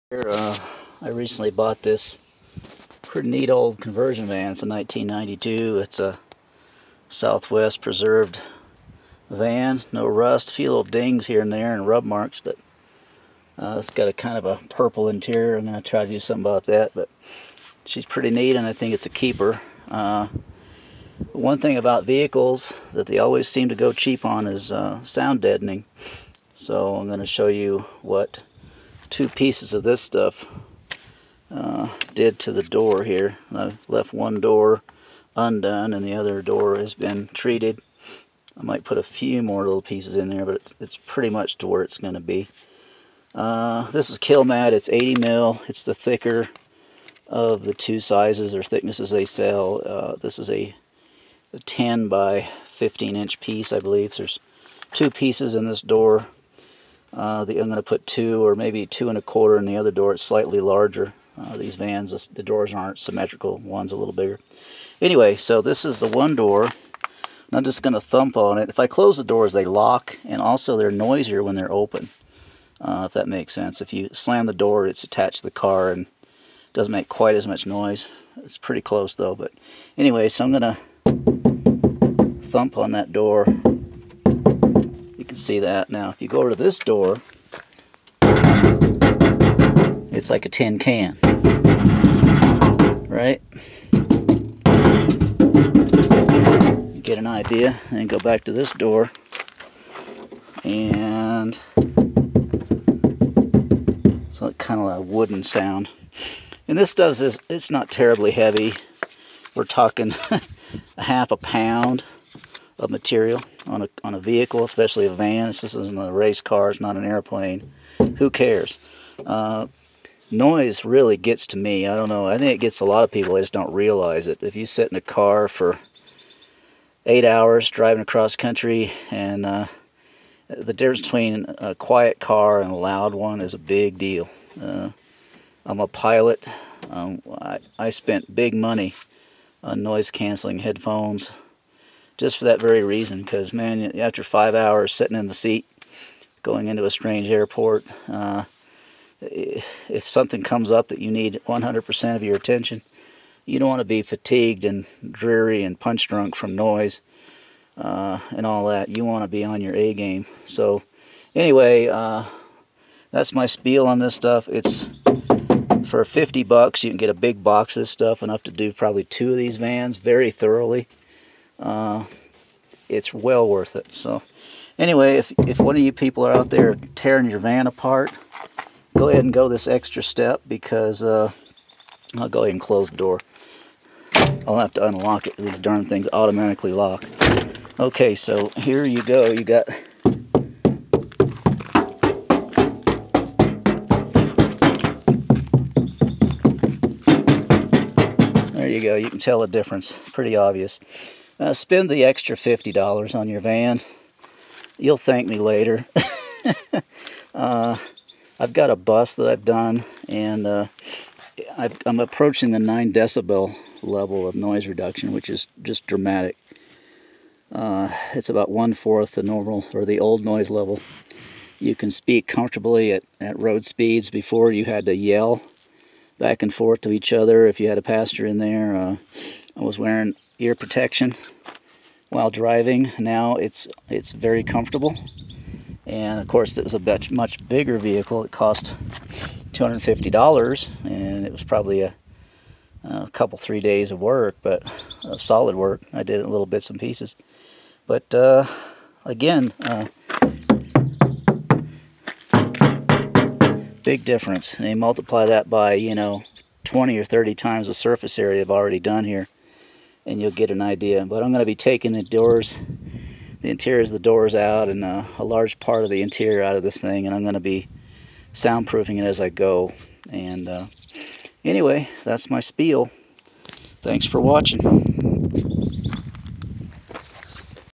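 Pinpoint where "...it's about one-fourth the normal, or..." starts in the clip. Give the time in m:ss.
3:38.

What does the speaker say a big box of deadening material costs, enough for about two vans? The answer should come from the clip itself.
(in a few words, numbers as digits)
$50.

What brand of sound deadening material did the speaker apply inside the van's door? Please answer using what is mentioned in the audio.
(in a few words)
Kilmat.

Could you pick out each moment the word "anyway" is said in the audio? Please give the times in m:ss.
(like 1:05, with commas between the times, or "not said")
1:05, 1:19, 2:41, 2:54, 4:31.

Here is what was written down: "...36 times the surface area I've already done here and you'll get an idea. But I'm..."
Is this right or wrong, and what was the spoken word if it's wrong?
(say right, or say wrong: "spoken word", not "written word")
wrong: "30", not "36".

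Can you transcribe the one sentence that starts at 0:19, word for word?
Uh, one thing about vehicles that they always seem to go cheap on is uh, sound deadening.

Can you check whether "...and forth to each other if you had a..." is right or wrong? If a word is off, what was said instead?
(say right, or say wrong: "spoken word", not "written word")
right.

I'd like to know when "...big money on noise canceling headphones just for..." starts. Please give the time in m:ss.
2:18.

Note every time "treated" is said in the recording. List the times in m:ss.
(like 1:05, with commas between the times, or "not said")
0:37.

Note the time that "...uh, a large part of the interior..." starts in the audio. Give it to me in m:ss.
4:24.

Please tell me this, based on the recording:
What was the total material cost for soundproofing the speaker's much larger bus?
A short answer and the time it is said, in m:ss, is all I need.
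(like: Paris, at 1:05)
$250, at 3:59.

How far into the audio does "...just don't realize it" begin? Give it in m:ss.
2:03.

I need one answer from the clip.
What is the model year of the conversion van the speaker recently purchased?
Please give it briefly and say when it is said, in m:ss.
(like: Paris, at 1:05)
1992, at 0:04.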